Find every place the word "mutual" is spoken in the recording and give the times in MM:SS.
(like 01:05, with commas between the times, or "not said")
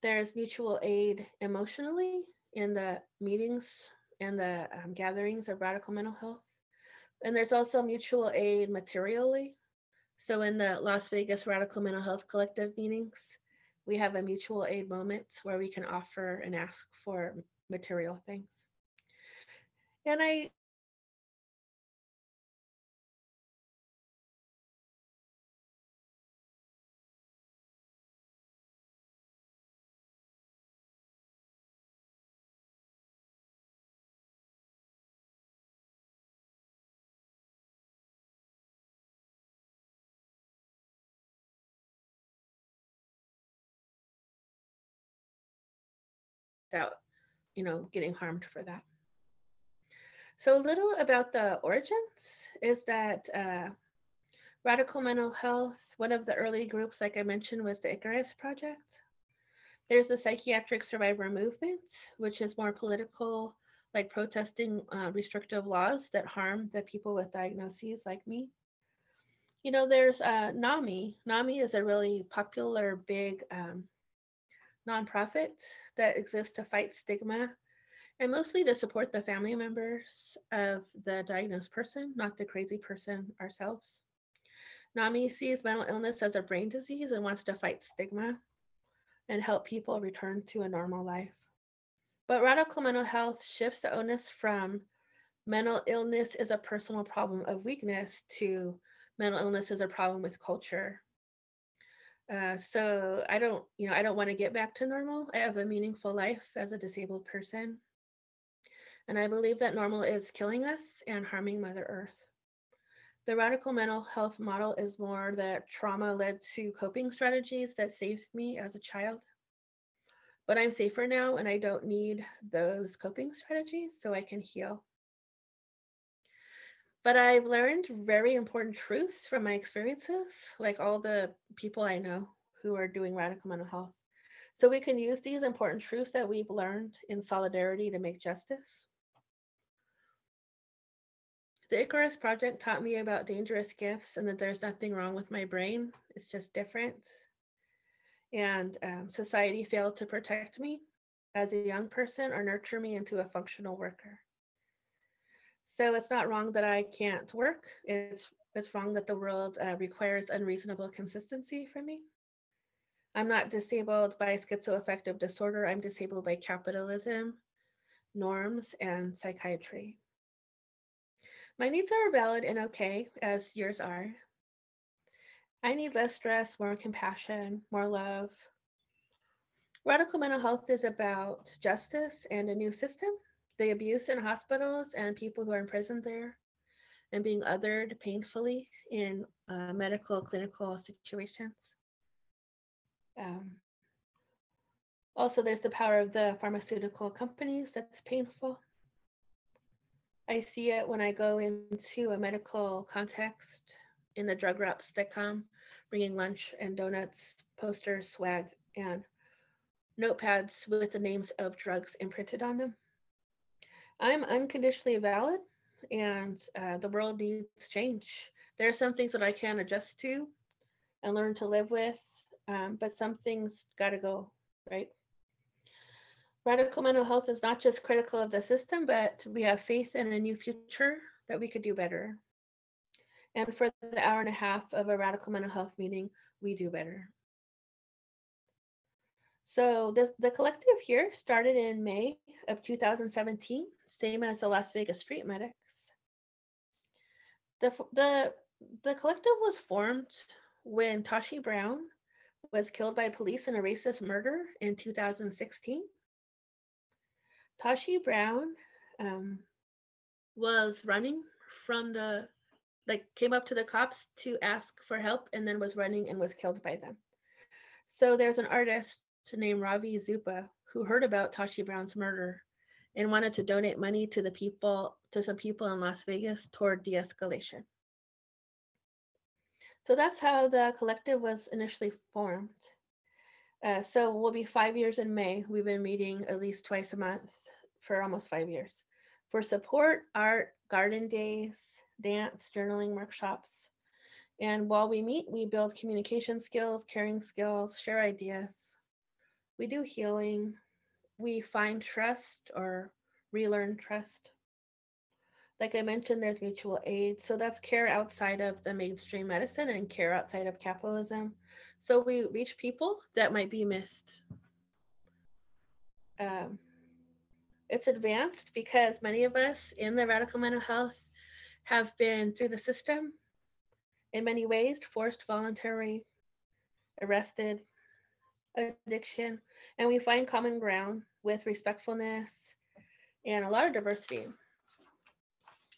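00:00, 00:07, 00:14, 05:06.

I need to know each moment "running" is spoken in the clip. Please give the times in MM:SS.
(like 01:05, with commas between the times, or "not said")
04:20, 04:25.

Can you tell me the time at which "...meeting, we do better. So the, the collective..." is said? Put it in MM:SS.
03:55.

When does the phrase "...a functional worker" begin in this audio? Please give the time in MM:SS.
02:33.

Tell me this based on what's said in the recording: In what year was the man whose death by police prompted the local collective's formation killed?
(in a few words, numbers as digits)
2016.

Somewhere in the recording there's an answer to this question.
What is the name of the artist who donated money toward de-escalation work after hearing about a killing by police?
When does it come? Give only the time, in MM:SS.
04:29.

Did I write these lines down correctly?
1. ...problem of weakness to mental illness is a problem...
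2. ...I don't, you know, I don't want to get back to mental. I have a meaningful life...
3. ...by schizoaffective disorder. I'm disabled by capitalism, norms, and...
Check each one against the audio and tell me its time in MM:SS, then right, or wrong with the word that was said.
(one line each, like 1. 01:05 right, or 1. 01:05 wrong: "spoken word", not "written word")
1. 01:37 right
2. 01:43 wrong: "normal", not "mental"
3. 02:44 right.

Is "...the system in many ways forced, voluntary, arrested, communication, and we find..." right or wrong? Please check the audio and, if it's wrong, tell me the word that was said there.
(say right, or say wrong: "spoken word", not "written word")
wrong: "addiction", not "communication".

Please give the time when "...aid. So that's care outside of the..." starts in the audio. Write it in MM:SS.
05:06.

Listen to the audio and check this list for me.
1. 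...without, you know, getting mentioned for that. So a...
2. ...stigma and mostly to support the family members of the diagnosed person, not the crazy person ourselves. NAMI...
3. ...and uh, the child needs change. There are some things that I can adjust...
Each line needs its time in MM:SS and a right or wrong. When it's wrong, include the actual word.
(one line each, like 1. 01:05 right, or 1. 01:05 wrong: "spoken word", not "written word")
1. 00:46 wrong: "harmed", not "mentioned"
2. 01:16 right
3. 03:35 wrong: "world", not "child".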